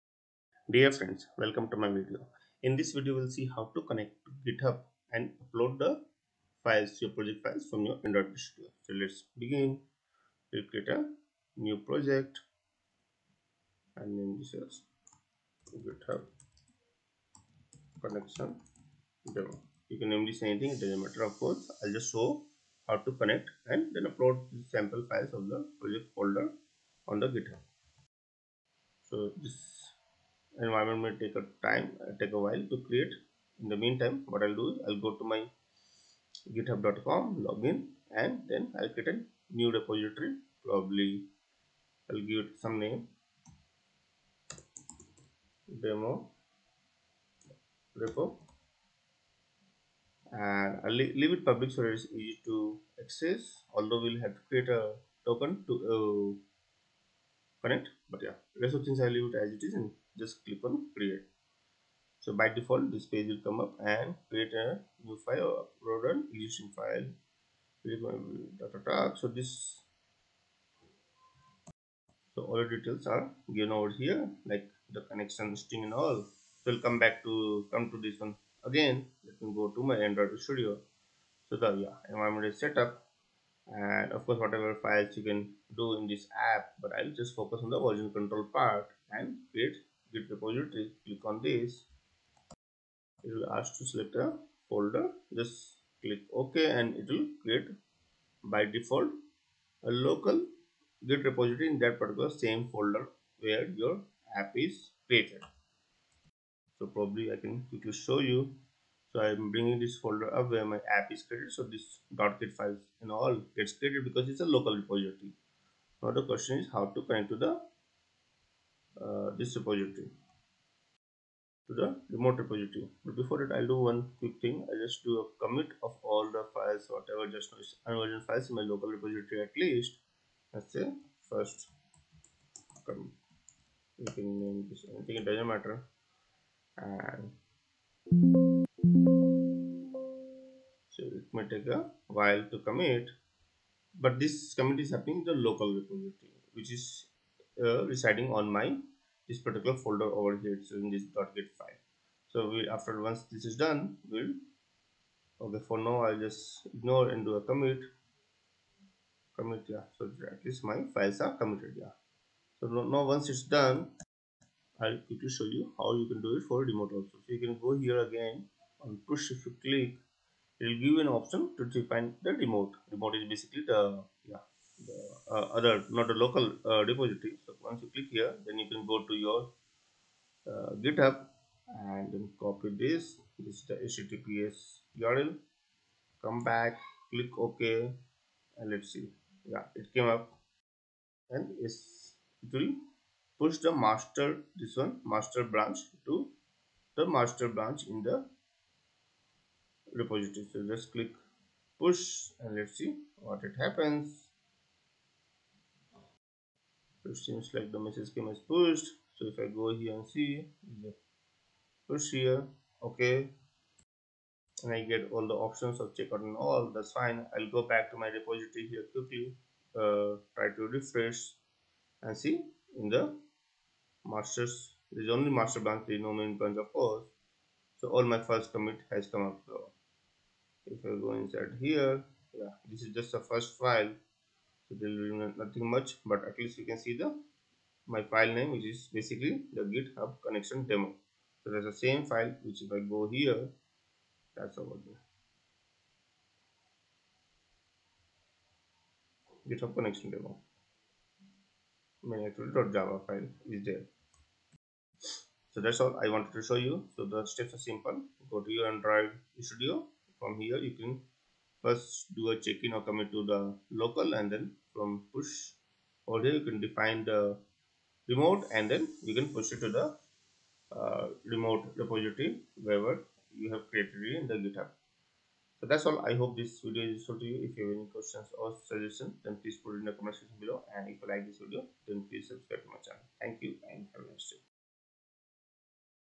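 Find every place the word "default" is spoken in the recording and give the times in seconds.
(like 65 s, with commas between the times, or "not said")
62 s, 98 s.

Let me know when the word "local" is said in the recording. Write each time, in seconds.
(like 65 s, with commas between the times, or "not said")
100 s, 114 s, 128 s, 145 s, 176 s, 263 s.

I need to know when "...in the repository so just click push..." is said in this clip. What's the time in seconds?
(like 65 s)
197 s.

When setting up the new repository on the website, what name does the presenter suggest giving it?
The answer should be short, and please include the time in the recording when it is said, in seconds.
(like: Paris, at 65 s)
demo repo, at 45 s.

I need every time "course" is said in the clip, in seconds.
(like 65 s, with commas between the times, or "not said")
21 s, 84 s, 226 s.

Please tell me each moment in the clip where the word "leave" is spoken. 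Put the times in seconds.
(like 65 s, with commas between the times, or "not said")
51 s, 59 s.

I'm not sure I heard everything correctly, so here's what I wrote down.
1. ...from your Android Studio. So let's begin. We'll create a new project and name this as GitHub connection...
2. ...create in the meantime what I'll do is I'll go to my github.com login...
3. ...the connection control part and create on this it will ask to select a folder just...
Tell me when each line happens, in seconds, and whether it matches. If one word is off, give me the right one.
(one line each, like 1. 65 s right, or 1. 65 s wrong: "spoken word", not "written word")
1. 7 s right
2. 32 s right
3. 87 s wrong: "version", not "connection".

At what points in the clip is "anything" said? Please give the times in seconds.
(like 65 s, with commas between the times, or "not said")
20 s, 134 s.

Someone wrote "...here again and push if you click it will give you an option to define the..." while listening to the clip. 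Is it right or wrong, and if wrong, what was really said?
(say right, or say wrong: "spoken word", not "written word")
right.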